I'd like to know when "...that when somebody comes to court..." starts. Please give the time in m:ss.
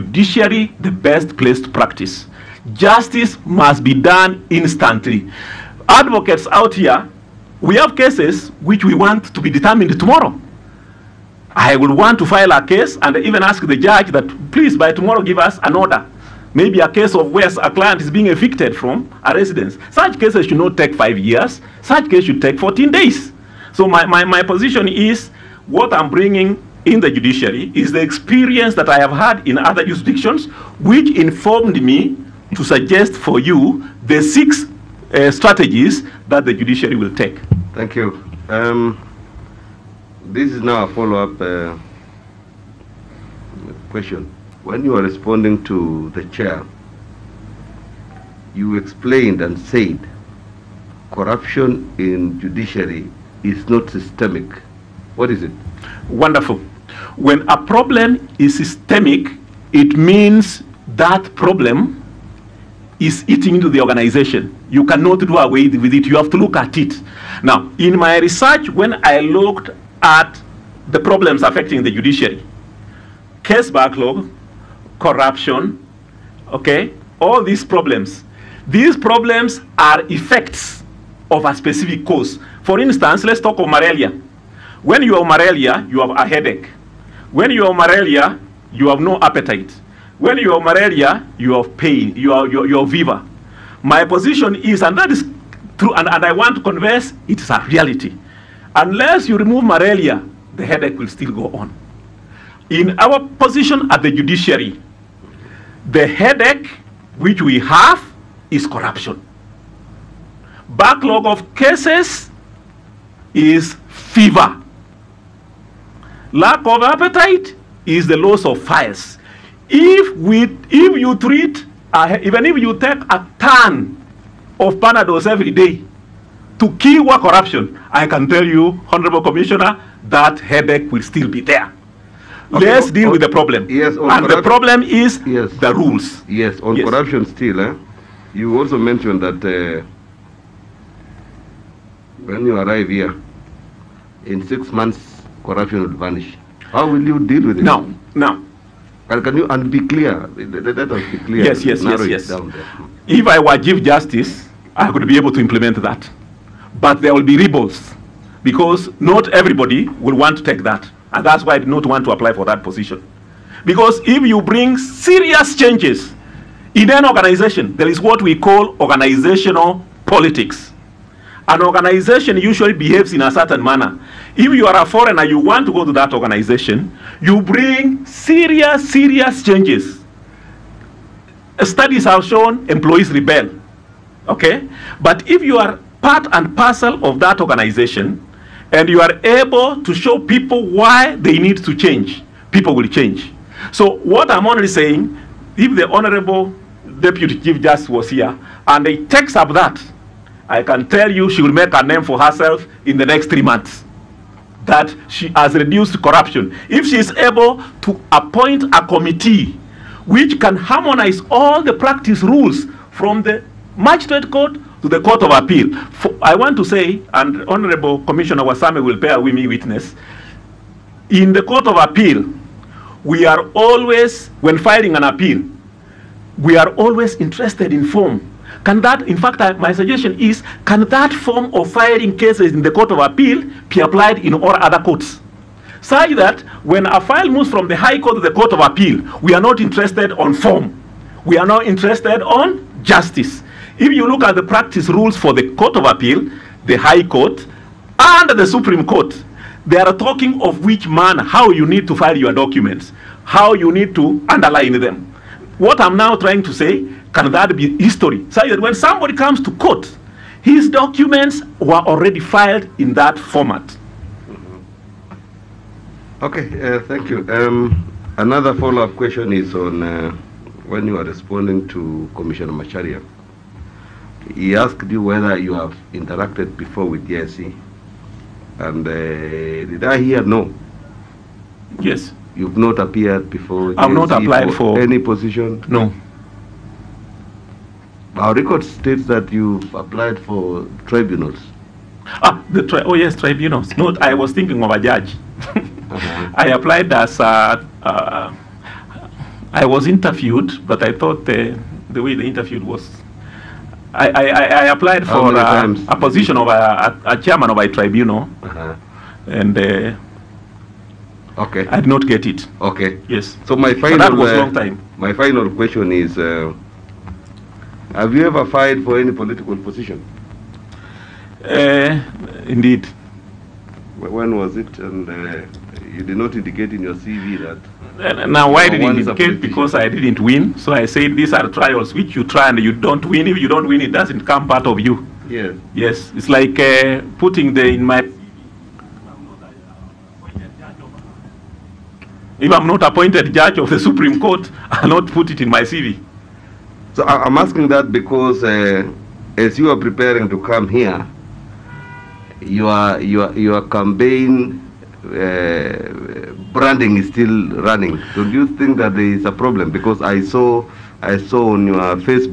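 4:18.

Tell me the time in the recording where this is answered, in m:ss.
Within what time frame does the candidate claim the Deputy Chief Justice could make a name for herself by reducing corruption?
3:23.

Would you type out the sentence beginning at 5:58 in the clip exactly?
do you think that there is a problem?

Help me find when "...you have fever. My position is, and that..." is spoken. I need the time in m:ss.
1:32.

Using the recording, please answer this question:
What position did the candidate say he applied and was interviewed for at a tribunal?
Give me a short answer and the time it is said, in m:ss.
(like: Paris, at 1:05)
Chairman of a tribunal, at 5:07.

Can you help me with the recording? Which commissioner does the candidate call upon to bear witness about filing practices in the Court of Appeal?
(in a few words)
Commissioner Warsame.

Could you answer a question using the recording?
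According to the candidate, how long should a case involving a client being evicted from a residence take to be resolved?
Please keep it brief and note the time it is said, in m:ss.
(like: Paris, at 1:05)
14 days, at 0:22.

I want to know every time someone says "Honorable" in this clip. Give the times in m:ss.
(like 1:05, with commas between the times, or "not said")
2:08, 3:15, 3:37.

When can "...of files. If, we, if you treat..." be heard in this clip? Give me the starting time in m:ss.
1:58.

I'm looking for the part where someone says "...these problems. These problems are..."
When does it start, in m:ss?
1:17.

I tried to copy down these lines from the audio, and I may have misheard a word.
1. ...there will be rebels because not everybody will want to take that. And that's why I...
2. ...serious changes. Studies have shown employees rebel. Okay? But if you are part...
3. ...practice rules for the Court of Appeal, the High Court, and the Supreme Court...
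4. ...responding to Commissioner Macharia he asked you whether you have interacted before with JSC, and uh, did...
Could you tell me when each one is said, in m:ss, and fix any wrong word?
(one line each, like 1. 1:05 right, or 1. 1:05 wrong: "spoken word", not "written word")
1. 2:36 right
2. 2:58 right
3. 4:04 right
4. 4:31 right.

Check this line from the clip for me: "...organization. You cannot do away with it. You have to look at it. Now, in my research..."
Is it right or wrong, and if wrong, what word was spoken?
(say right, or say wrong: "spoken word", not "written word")
right.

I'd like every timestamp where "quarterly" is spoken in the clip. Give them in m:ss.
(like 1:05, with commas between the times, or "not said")
not said.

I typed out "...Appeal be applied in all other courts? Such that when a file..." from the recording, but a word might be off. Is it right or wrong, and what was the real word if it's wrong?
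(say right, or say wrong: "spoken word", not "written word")
right.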